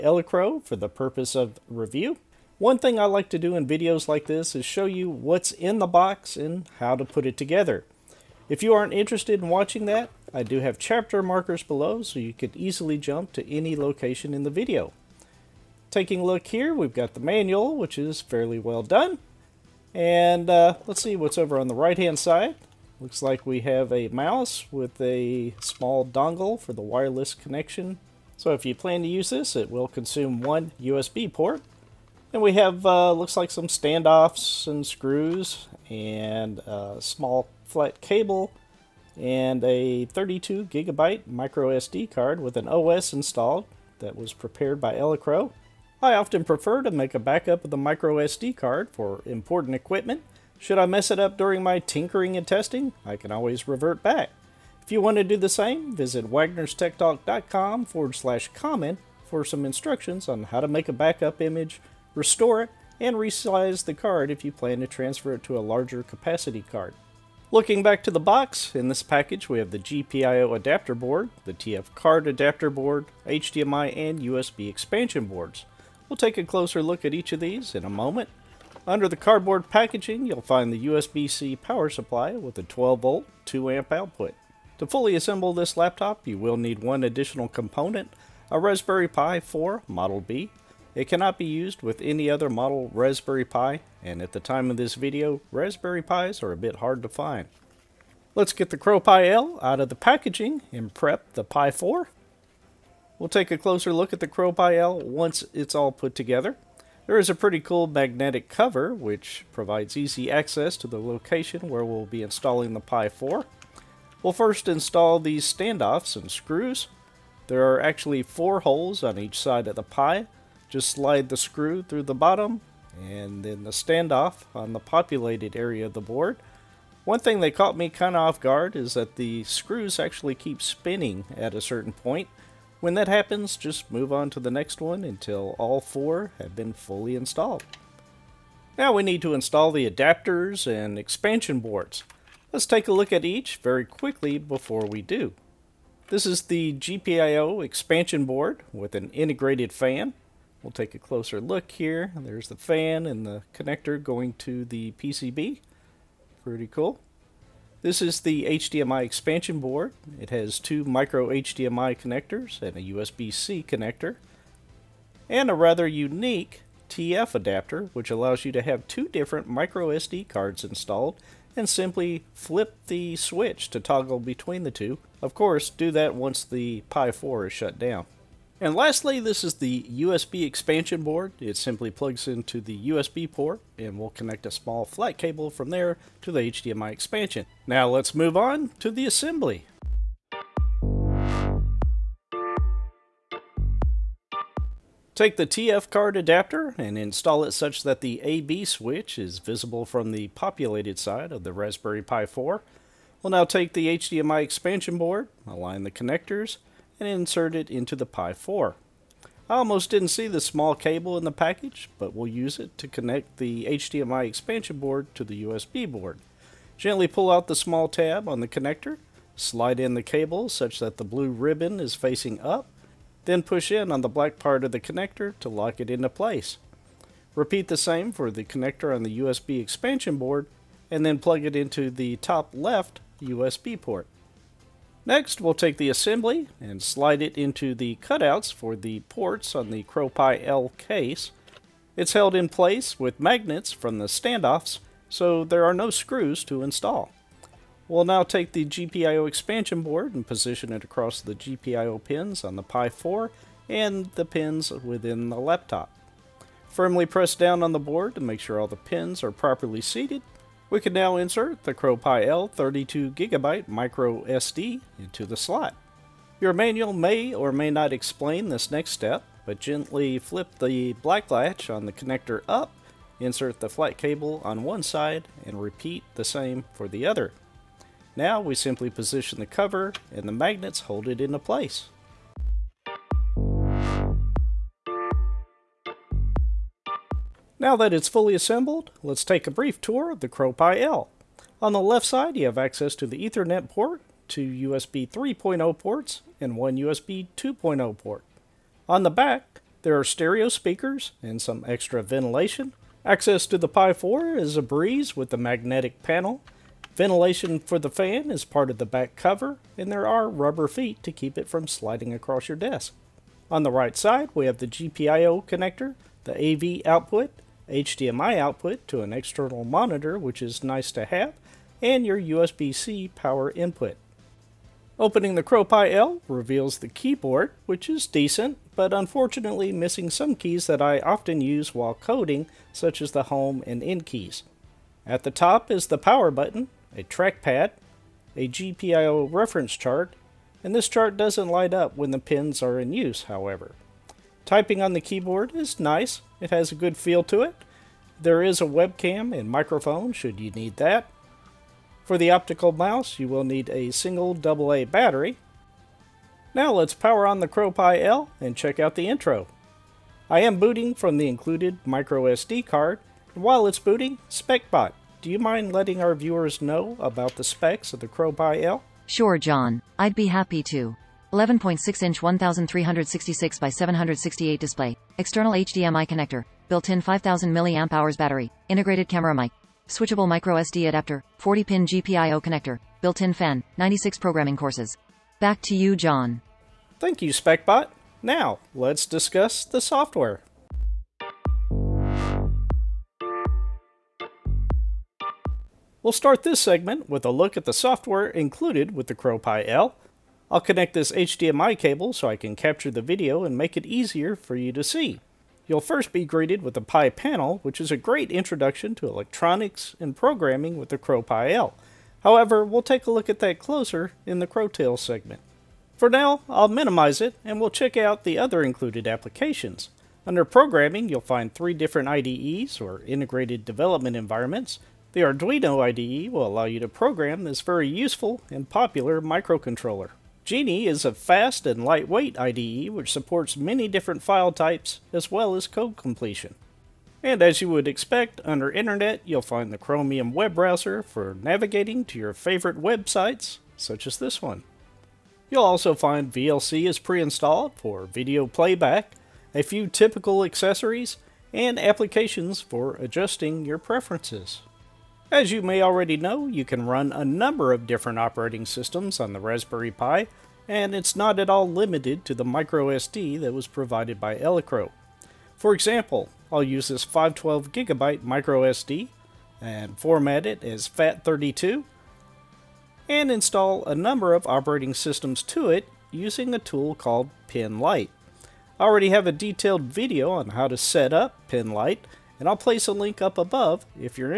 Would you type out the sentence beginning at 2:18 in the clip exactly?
Now we need to install the adapters and expansion boards.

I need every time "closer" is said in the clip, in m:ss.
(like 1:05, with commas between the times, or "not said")
1:16, 1:43, 2:30, 6:53.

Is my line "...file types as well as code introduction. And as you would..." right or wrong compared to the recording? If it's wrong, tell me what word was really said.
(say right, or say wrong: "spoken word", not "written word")
wrong: "completion", not "introduction".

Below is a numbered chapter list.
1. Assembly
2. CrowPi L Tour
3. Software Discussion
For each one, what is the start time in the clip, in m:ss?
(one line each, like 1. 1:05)
1. 3:09
2. 4:42
3. 6:30.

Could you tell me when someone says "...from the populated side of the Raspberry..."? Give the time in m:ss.
3:19.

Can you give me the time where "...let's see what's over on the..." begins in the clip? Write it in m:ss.
0:20.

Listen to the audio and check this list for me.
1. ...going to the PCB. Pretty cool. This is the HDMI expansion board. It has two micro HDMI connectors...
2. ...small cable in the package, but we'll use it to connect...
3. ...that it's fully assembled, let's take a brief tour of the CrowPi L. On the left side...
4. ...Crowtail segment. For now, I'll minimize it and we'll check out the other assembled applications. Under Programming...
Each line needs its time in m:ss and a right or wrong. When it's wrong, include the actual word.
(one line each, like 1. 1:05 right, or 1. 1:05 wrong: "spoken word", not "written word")
1. 2:34 right
2. 3:30 right
3. 4:47 right
4. 6:54 wrong: "included", not "assembled".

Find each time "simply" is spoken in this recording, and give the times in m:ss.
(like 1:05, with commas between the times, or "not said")
2:51, 3:01, 4:38.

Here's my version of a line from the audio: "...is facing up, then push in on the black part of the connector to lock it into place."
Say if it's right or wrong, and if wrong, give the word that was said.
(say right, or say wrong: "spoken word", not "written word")
right.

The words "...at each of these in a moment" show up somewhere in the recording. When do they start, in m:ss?
1:17.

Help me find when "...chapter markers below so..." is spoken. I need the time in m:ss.
0:10.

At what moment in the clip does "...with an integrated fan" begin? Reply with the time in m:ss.
2:28.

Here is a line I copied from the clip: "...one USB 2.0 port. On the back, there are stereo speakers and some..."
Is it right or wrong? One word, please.
right.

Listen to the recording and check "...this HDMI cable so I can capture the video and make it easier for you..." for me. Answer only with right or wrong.
right.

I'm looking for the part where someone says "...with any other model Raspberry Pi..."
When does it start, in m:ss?
1:31.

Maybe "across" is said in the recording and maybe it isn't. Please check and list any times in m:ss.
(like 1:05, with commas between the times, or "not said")
4:10, 5:12.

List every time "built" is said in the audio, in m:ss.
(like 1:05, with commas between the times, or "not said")
6:16, 6:23.